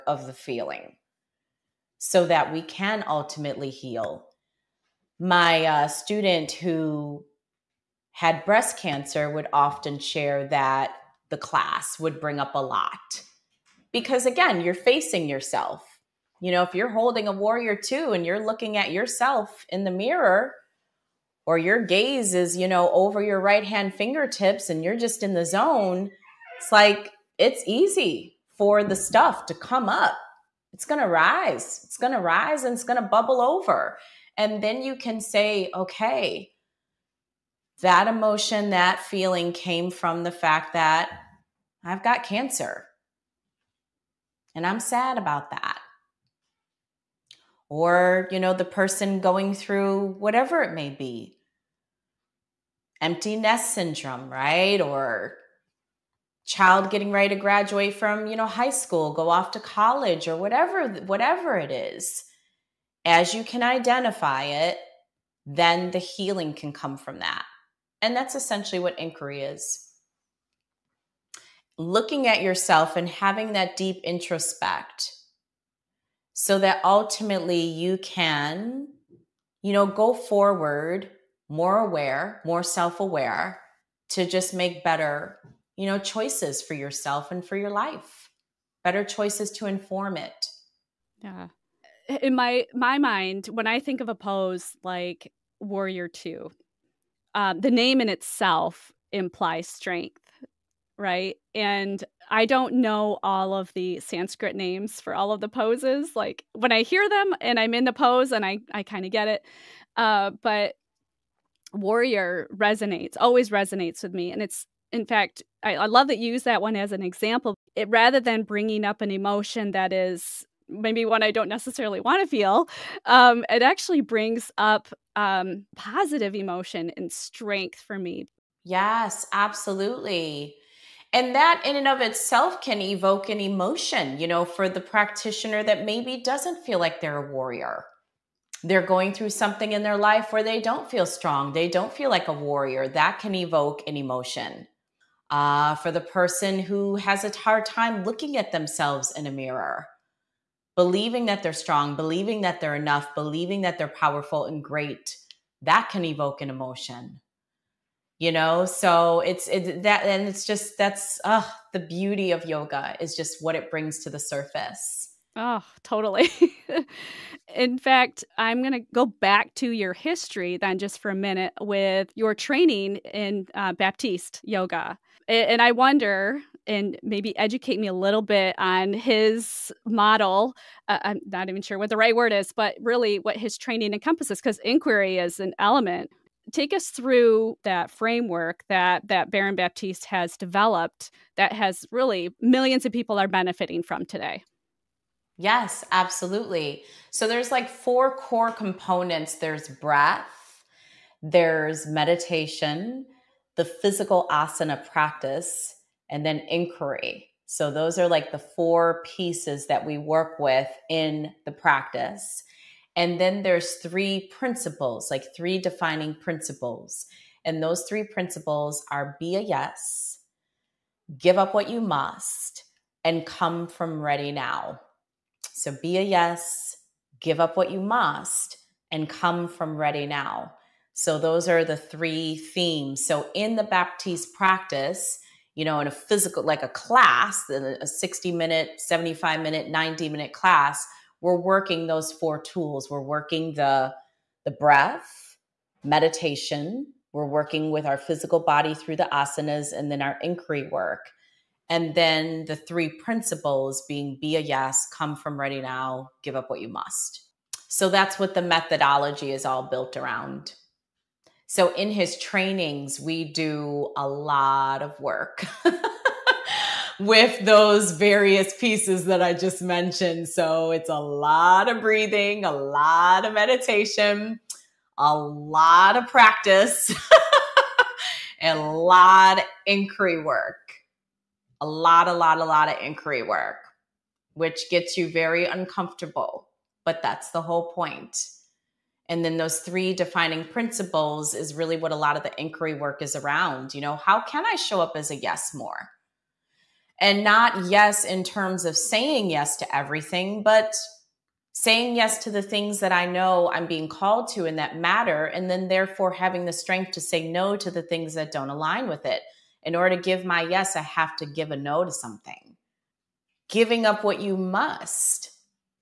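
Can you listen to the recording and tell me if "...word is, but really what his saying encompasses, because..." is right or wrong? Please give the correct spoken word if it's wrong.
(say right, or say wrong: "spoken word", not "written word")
wrong: "training", not "saying".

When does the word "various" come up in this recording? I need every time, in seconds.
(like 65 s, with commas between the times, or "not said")
267 s.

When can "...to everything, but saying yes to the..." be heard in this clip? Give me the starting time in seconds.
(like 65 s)
299 s.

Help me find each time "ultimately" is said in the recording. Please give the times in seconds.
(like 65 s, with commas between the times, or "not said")
3 s, 76 s.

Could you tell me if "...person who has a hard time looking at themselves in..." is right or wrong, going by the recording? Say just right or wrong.
right.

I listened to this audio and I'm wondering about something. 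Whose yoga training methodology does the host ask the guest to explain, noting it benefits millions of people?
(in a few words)
Baron Baptiste.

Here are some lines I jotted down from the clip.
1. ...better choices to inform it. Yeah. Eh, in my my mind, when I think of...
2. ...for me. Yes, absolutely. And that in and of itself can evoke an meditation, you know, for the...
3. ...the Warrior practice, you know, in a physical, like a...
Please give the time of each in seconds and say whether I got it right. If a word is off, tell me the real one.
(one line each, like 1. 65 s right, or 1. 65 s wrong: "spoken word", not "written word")
1. 88 s right
2. 127 s wrong: "emotion", not "meditation"
3. 233 s wrong: "Baptiste", not "Warrior".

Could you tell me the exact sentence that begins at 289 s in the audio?
And then those three defining principles is really what a lot of the inquiry work is around.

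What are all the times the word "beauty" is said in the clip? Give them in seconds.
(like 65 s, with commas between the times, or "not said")
161 s.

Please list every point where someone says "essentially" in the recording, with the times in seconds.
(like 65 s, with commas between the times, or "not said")
68 s.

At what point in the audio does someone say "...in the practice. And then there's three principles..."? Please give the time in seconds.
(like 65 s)
210 s.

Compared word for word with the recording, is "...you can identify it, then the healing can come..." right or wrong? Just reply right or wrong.
right.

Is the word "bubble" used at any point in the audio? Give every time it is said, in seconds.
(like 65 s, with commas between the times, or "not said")
33 s.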